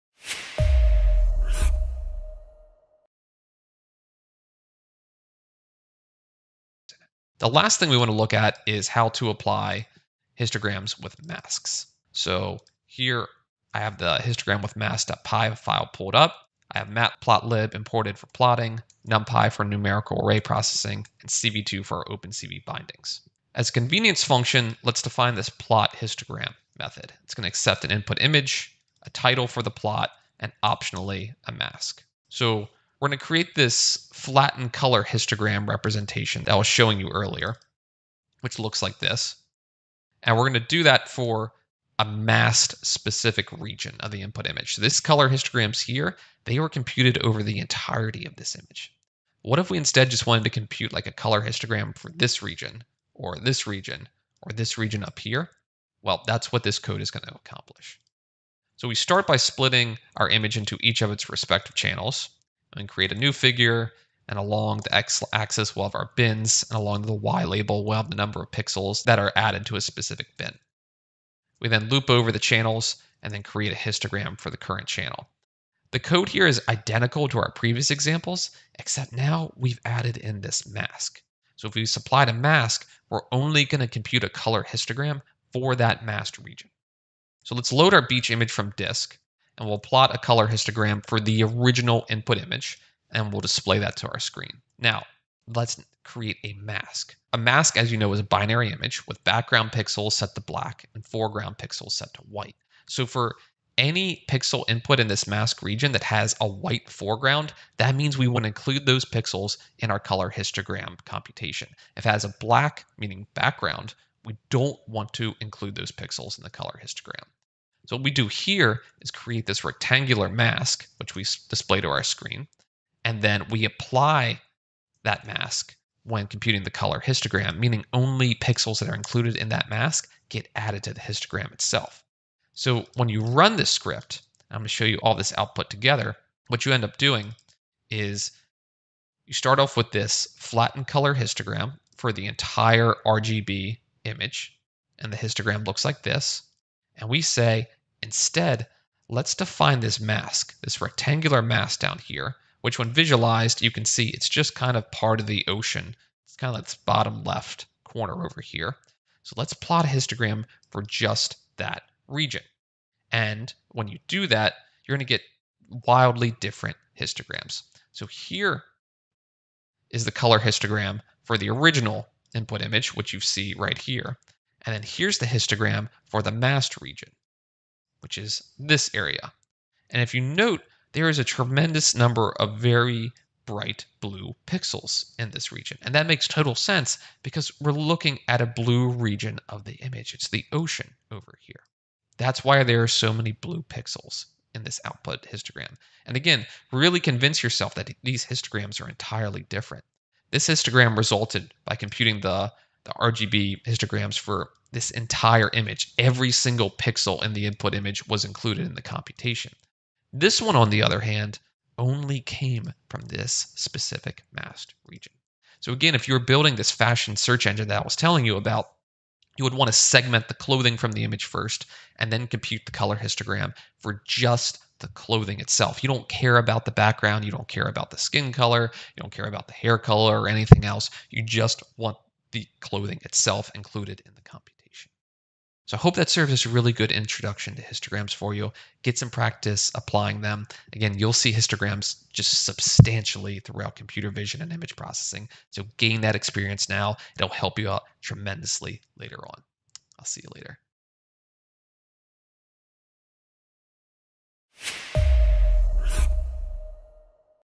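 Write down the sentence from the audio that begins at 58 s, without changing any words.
So we start by splitting our image into each of its respective channels and create a new figure.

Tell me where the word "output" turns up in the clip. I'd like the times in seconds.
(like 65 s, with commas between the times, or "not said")
135 s, 194 s.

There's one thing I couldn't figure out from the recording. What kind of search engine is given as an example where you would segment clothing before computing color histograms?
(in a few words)
fashion search engine.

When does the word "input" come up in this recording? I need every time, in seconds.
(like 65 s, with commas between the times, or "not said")
27 s, 44 s, 92 s, 104 s, 172 s, 207 s.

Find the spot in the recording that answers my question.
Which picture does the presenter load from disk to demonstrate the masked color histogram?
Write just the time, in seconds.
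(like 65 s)
88 s.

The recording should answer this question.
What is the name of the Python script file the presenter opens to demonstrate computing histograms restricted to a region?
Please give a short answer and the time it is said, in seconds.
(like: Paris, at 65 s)
histogram with mask.py, at 14 s.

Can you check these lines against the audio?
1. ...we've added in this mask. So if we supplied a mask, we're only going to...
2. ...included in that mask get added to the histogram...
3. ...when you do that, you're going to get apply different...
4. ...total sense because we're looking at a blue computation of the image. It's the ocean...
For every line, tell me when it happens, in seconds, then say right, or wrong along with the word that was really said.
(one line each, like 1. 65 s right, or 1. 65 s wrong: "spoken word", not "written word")
1. 79 s right
2. 128 s right
3. 163 s wrong: "wildly", not "apply"
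4. 186 s wrong: "region", not "computation".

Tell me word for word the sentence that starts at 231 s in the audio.
You just want the clothing itself included in the computation.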